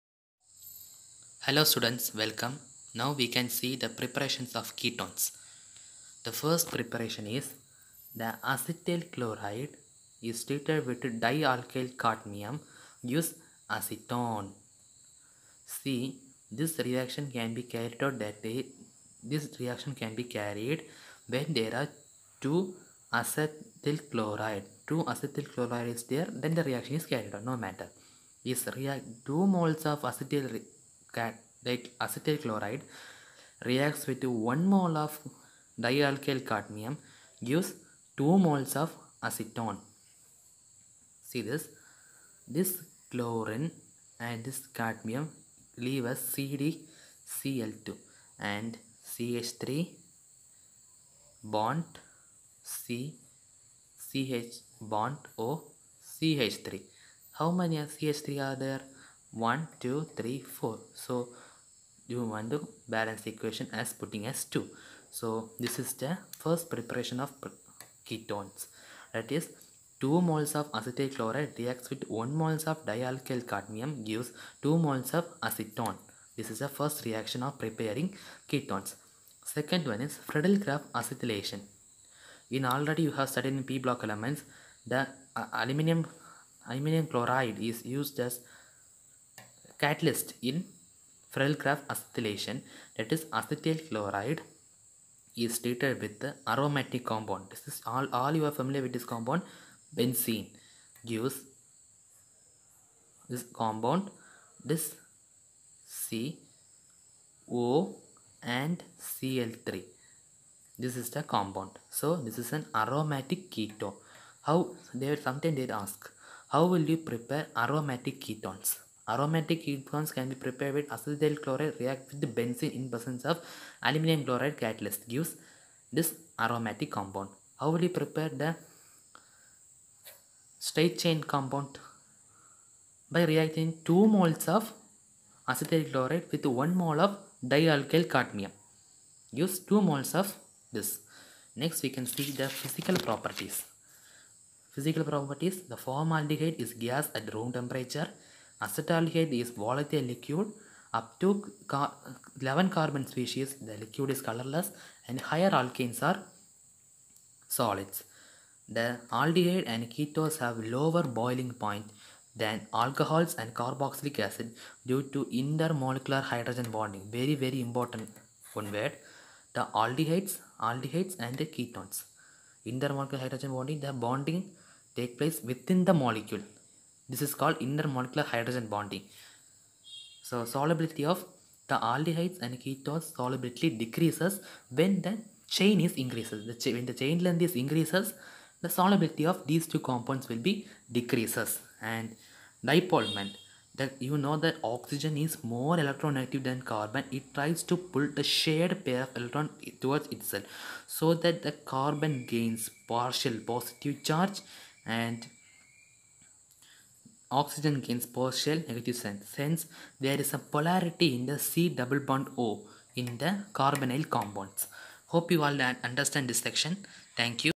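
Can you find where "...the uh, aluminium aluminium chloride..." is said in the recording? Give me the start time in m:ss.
1:24.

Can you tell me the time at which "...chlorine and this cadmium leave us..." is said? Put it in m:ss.
0:43.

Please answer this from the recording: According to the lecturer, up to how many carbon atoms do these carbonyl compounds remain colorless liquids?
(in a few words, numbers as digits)
11.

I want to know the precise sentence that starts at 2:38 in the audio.
The aldehyde and ketones have lower boiling point than alcohols and carboxylic acid due to intermolecular hydrogen bonding.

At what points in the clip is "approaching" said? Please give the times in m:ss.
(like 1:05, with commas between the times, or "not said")
not said.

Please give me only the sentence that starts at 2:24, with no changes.
Physical properties, the formaldehyde is gas at room temperature.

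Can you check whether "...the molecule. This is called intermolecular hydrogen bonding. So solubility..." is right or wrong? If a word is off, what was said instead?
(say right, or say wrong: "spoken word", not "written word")
right.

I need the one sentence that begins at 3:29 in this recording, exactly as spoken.
Since there is a polarity in the C double bond O in the carbonyl compounds.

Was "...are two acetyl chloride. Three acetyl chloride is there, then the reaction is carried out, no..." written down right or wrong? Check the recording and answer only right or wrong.
wrong.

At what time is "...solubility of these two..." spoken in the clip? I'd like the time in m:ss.
3:08.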